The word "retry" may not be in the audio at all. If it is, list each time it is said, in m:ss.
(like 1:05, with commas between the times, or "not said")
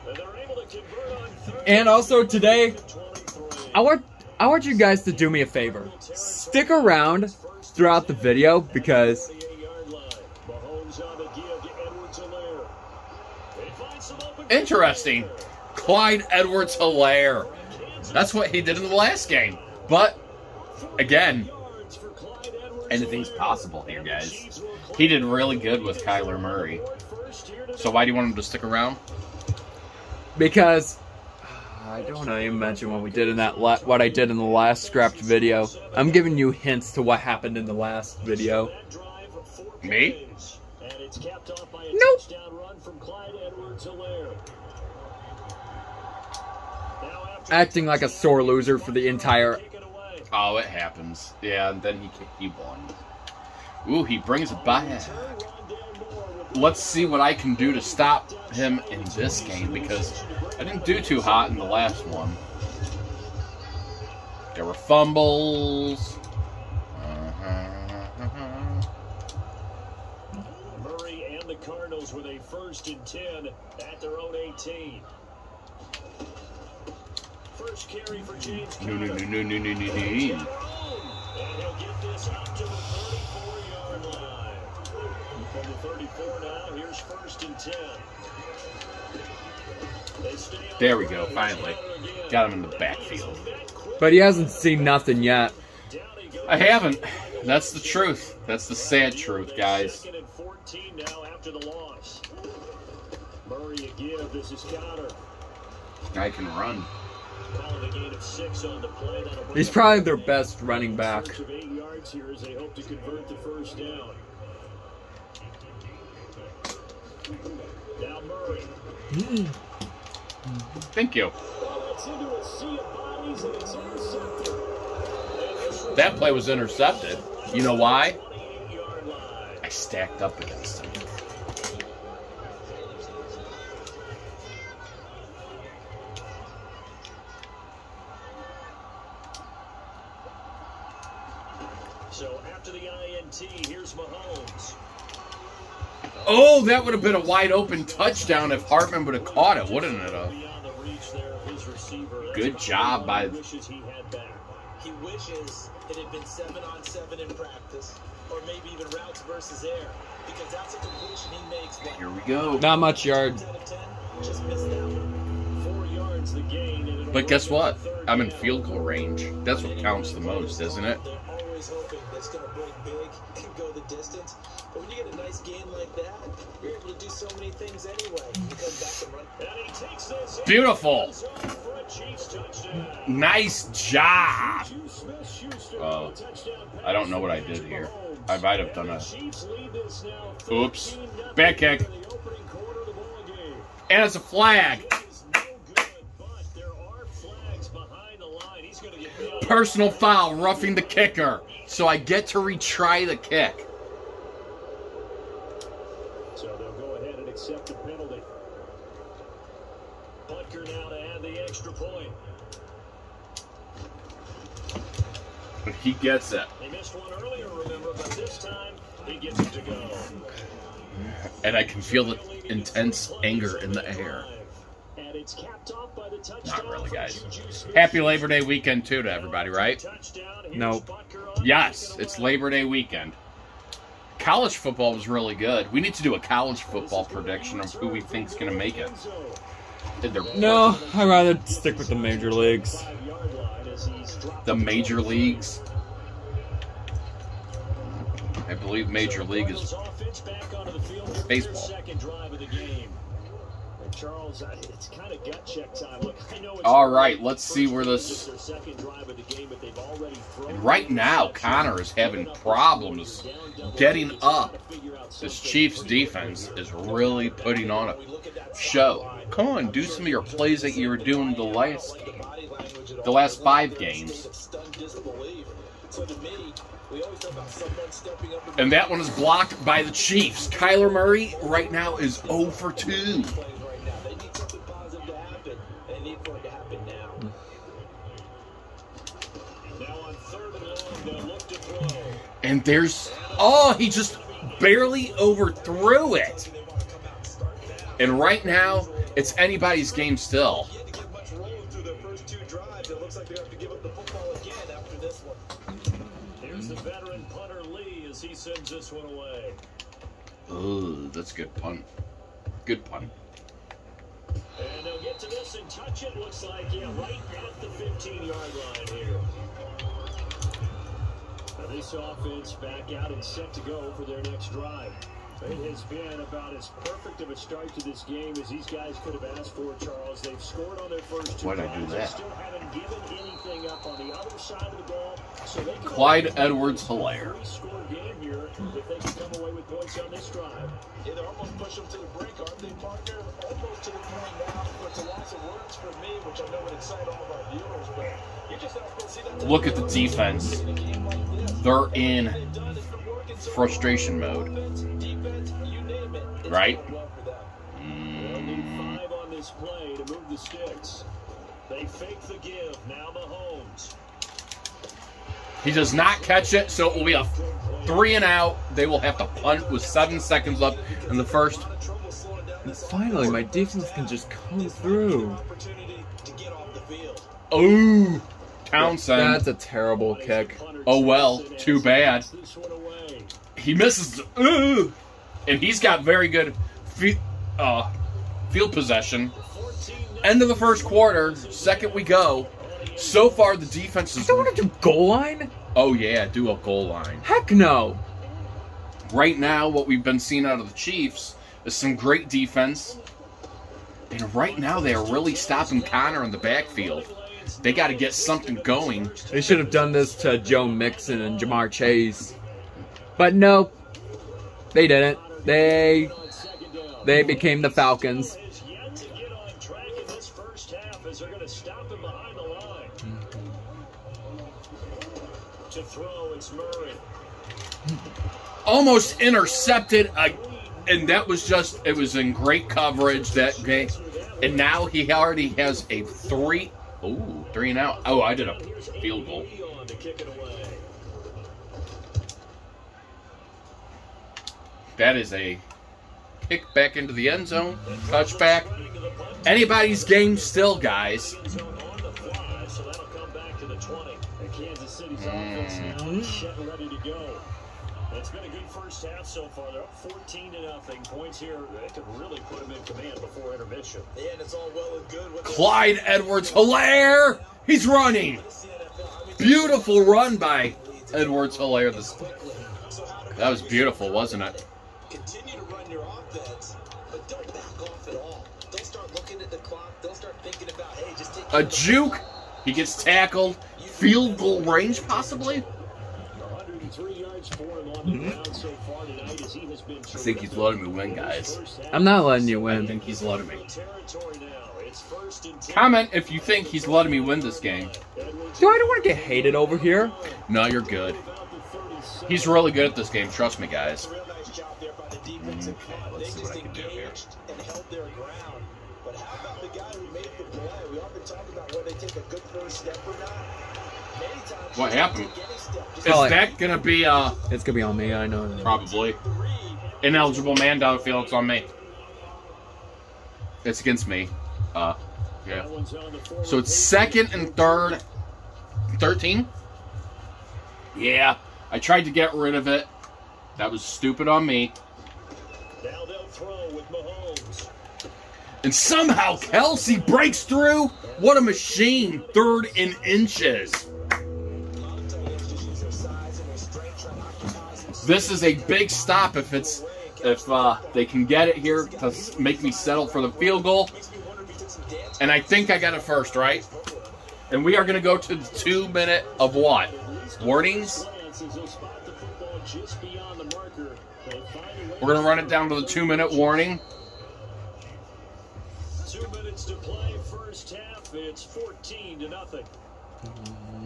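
3:22.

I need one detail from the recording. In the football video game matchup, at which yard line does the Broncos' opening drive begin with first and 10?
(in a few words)
18.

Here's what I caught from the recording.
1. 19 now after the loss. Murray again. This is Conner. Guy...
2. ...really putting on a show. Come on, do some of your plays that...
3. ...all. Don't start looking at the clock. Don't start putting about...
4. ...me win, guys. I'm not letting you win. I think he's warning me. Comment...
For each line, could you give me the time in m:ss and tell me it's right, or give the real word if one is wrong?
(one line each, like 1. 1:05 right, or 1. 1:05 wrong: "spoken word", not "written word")
1. 1:40 right
2. 4:26 right
3. 7:58 wrong: "thinking", not "putting"
4. 8:10 wrong: "letting", not "warning".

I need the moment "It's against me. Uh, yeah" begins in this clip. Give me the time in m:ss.
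8:43.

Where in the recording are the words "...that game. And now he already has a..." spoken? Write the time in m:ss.
7:13.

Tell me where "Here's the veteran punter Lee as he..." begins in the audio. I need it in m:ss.
5:06.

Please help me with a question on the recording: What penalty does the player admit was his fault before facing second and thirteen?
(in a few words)
Ineligible man downfield.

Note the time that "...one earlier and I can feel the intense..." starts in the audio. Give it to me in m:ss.
3:36.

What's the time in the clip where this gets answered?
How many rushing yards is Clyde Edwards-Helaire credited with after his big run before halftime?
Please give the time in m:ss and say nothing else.
8:05.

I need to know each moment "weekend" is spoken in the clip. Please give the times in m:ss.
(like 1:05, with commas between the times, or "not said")
3:48, 3:52.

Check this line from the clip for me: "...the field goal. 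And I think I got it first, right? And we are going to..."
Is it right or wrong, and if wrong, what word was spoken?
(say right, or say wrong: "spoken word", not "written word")
right.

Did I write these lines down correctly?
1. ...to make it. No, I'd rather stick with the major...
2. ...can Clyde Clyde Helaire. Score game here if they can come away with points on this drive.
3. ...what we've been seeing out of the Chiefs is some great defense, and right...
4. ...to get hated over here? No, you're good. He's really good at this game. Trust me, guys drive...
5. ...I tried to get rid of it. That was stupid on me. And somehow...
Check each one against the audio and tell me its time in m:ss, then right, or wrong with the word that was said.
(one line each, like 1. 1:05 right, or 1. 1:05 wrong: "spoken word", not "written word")
1. 3:58 right
2. 5:35 wrong: "Edwards", not "Clyde"
3. 6:39 right
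4. 8:19 wrong: "defensive", not "drive"
5. 8:51 right.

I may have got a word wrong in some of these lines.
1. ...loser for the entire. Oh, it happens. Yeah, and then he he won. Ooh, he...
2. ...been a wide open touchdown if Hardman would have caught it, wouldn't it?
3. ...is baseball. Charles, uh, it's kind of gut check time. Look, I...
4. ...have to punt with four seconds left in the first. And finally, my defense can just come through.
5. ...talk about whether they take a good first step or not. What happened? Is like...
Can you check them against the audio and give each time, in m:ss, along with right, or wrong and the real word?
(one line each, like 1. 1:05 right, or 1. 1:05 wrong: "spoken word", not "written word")
1. 0:48 right
2. 2:27 right
3. 4:09 right
4. 6:08 wrong: "seven", not "four"
5. 8:31 right.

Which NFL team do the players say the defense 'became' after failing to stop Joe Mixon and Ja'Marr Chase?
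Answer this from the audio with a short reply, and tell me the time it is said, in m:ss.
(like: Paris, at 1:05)
Falcons, at 6:57.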